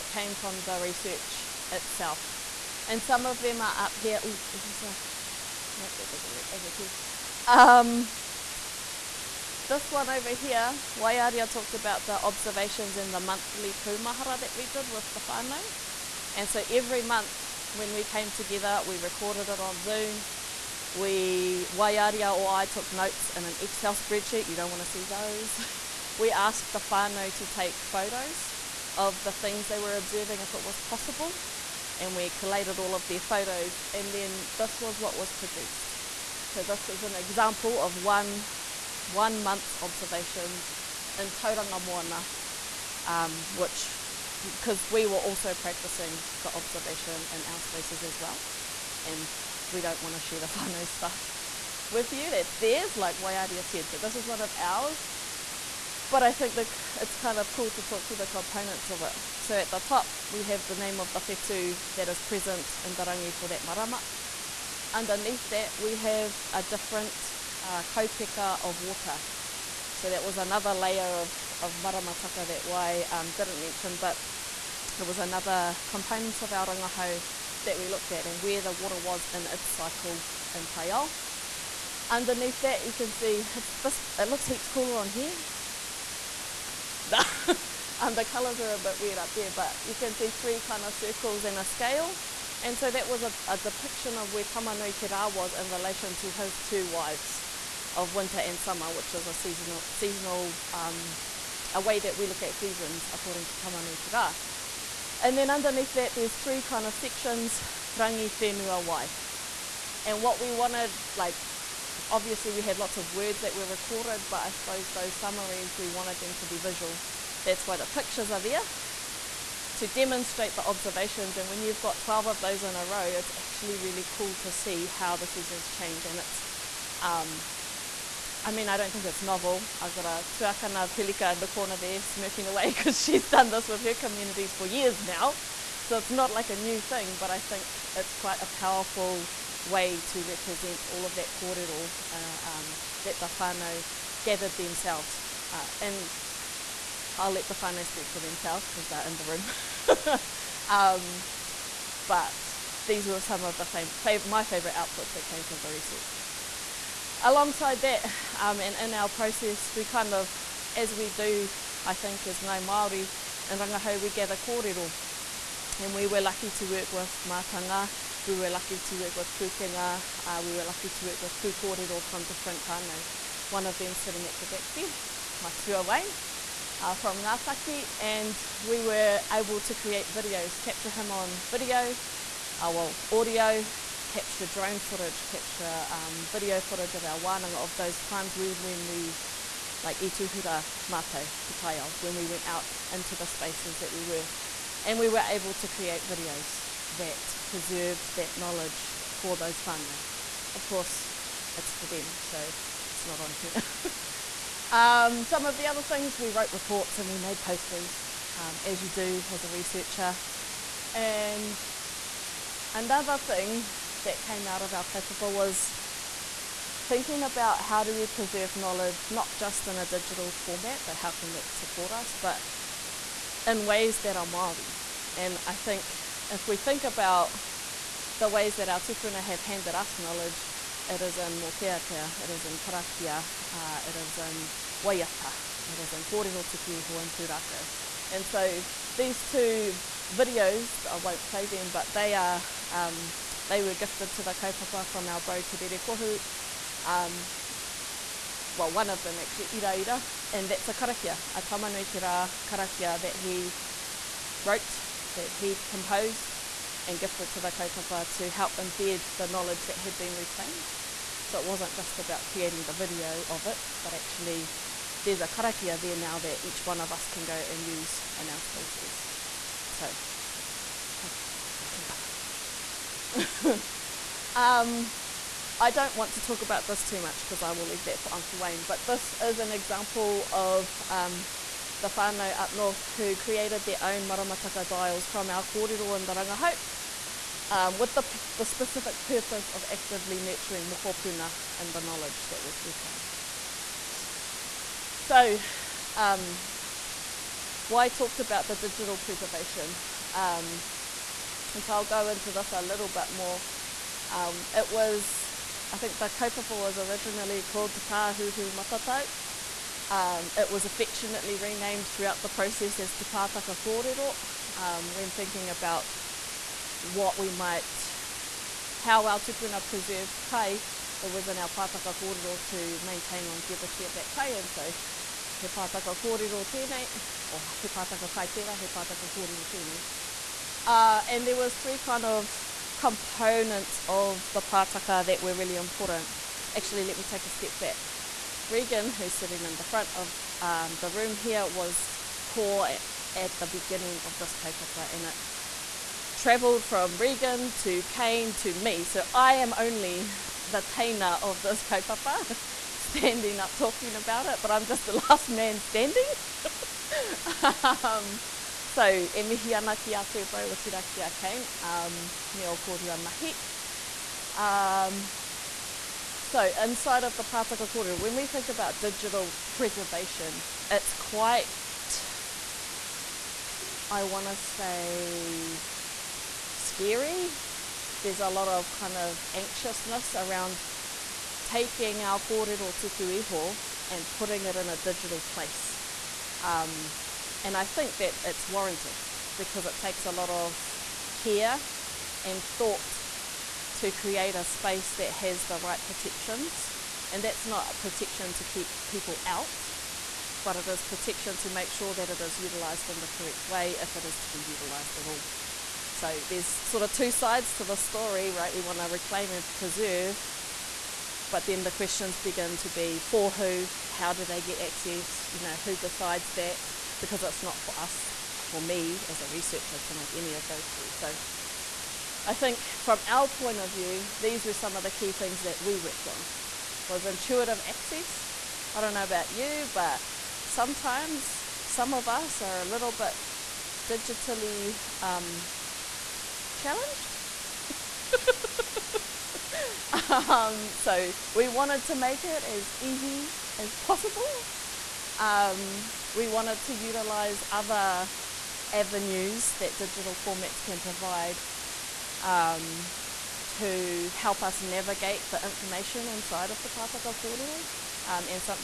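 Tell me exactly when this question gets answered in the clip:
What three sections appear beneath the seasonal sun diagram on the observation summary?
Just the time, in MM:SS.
01:47.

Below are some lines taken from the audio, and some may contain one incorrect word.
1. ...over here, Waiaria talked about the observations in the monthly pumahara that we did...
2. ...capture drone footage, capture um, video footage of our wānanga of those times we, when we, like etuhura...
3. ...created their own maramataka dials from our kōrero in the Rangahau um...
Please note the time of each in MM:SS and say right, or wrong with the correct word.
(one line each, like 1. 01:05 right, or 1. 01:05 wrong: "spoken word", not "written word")
1. 00:10 right
2. 03:04 right
3. 04:43 right.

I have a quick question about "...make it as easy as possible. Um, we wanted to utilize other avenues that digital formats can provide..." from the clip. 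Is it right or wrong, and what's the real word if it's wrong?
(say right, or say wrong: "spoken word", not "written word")
right.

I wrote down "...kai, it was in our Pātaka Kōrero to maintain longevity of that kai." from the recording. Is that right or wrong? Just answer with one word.
right.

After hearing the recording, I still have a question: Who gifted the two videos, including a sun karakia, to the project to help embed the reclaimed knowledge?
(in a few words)
Te Rere Kohu.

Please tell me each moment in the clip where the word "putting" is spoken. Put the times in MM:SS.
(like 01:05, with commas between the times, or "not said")
06:24.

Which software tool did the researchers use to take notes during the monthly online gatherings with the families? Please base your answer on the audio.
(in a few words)
Excel spreadsheet.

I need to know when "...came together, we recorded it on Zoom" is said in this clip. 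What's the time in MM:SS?
00:18.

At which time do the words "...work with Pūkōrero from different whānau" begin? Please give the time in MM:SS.
02:51.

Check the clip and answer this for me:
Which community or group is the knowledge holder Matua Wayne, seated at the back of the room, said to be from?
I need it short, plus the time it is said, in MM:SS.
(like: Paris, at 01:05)
Ngātaki, at 02:57.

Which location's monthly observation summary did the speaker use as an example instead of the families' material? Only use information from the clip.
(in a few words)
Tauranga Moana.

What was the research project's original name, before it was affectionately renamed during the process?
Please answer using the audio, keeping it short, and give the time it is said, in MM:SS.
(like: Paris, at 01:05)
Te Tāhuhu Matatau, at 05:07.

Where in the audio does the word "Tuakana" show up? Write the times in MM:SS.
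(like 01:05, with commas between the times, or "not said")
02:10.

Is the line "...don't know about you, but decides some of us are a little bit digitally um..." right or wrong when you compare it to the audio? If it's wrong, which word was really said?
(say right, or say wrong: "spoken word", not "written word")
wrong: "sometimes", not "decides".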